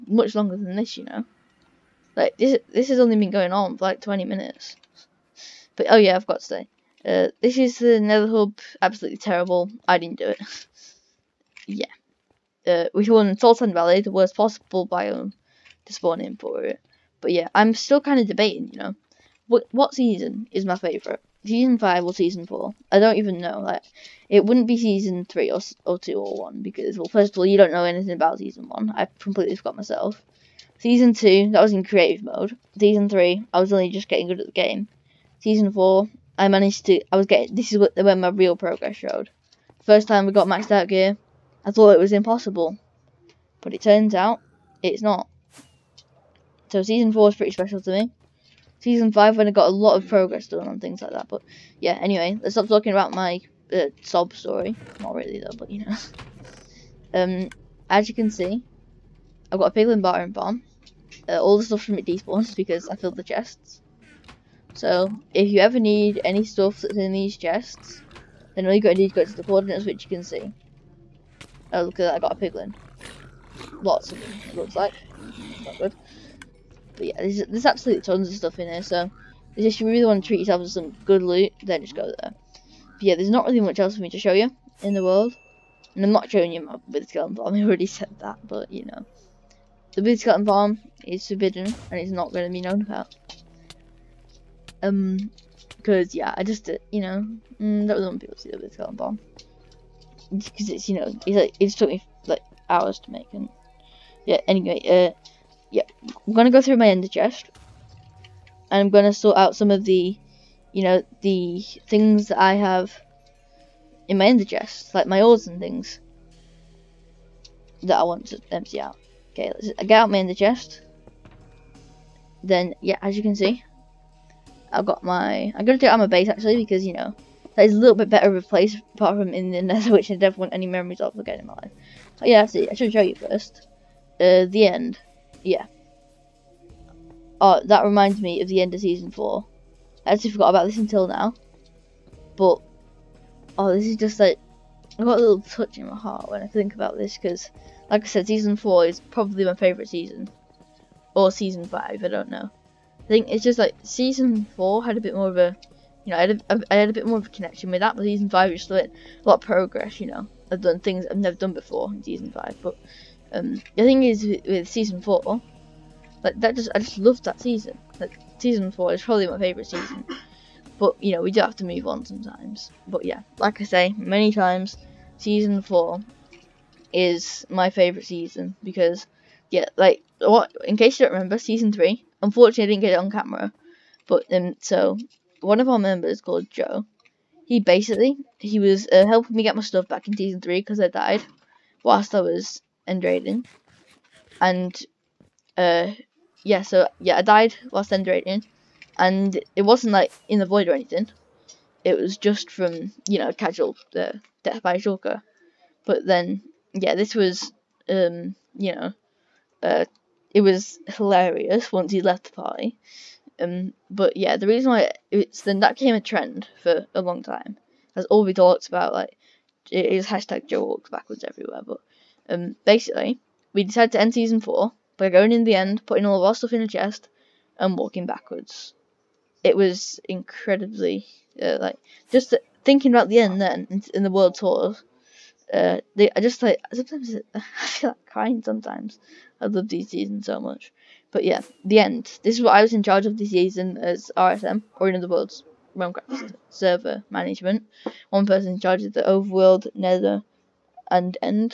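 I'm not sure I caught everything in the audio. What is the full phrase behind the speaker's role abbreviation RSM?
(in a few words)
Realmcraft server management.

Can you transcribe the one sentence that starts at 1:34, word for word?
Um, because yeah, I just, uh, you know, mm, that was one people see the wither skeleton farm.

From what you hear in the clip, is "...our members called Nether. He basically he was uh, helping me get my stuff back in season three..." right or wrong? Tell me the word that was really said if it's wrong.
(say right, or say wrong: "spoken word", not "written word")
wrong: "Joe", not "Nether".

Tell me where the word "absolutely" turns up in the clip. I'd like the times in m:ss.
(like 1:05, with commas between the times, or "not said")
0:08, 1:17.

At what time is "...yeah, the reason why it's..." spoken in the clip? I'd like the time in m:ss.
3:34.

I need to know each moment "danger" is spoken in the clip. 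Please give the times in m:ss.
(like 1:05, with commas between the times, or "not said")
not said.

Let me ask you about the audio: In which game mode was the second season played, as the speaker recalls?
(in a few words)
Creative mode.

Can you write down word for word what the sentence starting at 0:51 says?
But yeah, anyway, let's stop talking about my uh, sob story.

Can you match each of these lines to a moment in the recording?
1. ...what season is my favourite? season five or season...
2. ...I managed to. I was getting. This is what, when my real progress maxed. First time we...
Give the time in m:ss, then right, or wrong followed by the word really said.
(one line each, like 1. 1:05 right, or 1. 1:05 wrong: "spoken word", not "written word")
1. 0:19 right
2. 0:36 wrong: "showed", not "maxed".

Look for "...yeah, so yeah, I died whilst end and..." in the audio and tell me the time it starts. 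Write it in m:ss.
3:16.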